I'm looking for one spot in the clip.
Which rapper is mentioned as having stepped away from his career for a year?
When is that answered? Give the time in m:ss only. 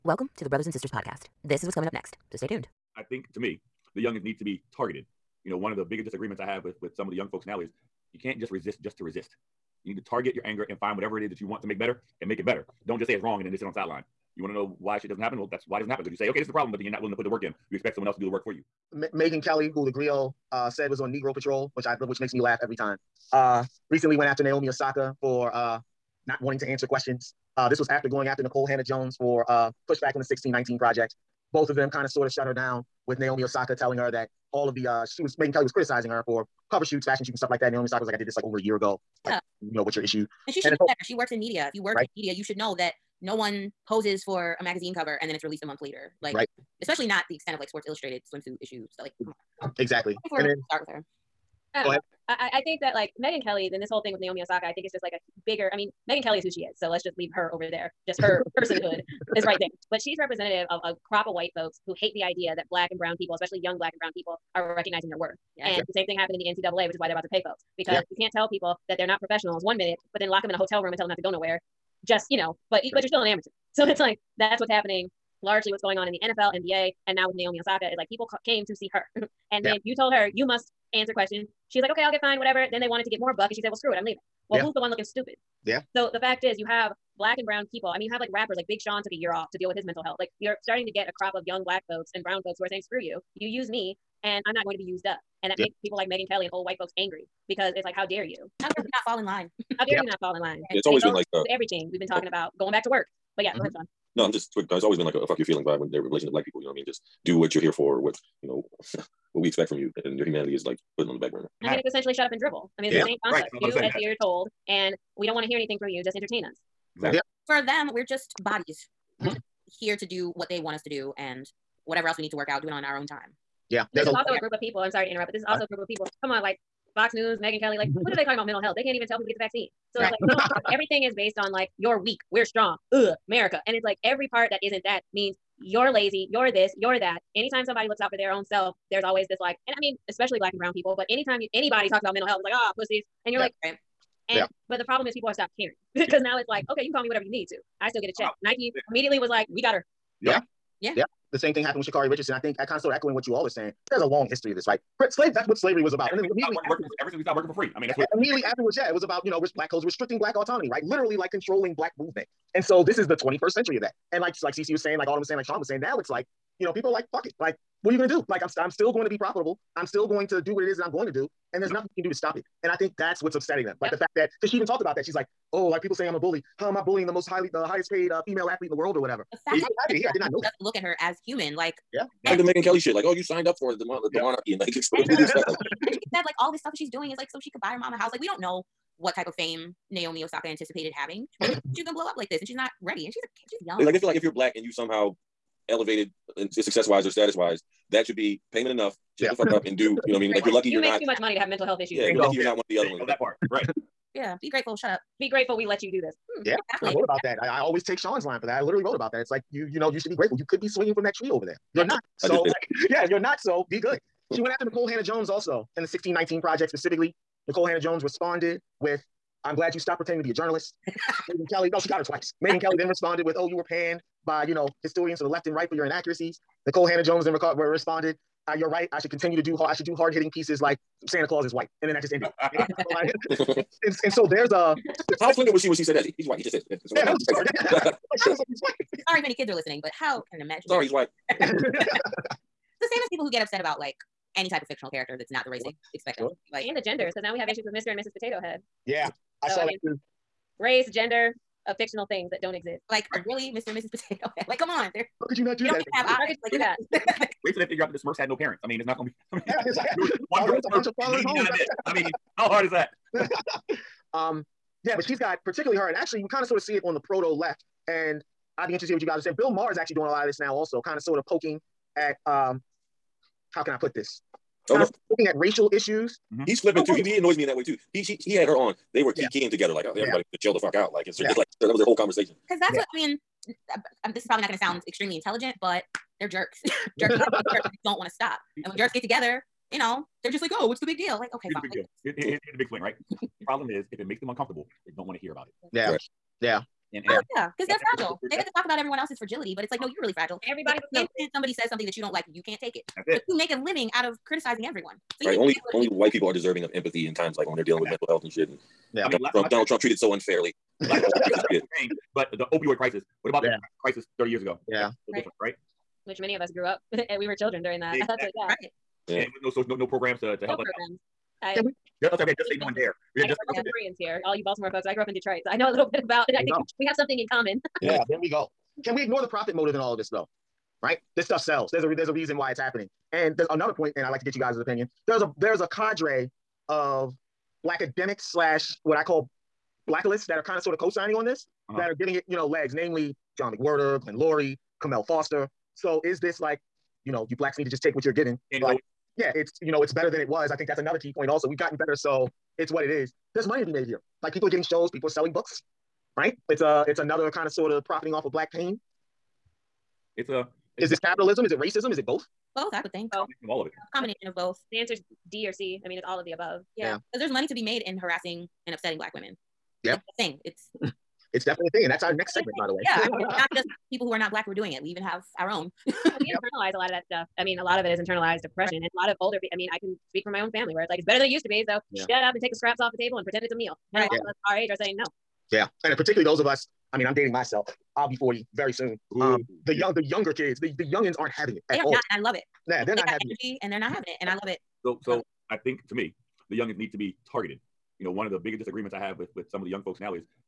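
1:28.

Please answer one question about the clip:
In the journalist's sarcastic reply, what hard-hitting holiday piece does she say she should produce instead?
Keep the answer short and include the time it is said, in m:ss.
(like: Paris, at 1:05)
Santa Claus is white, at 3:51.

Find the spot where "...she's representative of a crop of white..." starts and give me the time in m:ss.
0:59.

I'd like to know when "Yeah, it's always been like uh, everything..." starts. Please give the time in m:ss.
1:40.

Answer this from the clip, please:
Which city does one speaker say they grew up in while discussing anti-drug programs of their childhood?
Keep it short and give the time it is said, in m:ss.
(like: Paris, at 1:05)
Detroit, at 5:25.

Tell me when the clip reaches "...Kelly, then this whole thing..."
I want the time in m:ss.
0:53.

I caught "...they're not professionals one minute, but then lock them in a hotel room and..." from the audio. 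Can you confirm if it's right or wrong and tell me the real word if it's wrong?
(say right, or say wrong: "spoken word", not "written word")
right.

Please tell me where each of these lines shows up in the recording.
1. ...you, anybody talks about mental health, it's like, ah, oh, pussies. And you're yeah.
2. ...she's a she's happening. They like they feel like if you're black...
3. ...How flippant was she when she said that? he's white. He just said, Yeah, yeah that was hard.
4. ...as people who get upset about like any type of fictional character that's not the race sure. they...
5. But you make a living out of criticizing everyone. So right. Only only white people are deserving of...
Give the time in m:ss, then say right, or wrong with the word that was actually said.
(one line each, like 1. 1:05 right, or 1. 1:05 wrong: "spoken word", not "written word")
1. 2:21 right
2. 3:13 wrong: "young", not "happening"
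3. 3:55 right
4. 4:02 right
5. 5:03 right.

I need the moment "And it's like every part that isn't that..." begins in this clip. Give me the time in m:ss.
2:13.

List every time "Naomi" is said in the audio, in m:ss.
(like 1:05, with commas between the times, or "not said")
0:24, 0:33, 0:37, 0:54, 1:17, 3:09.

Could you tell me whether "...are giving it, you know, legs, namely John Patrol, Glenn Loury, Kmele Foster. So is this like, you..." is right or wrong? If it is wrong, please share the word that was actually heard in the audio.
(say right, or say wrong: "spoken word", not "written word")
wrong: "McWhorter", not "Patrol".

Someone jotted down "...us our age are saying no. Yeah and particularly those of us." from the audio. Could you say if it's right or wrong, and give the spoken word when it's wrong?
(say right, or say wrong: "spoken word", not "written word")
right.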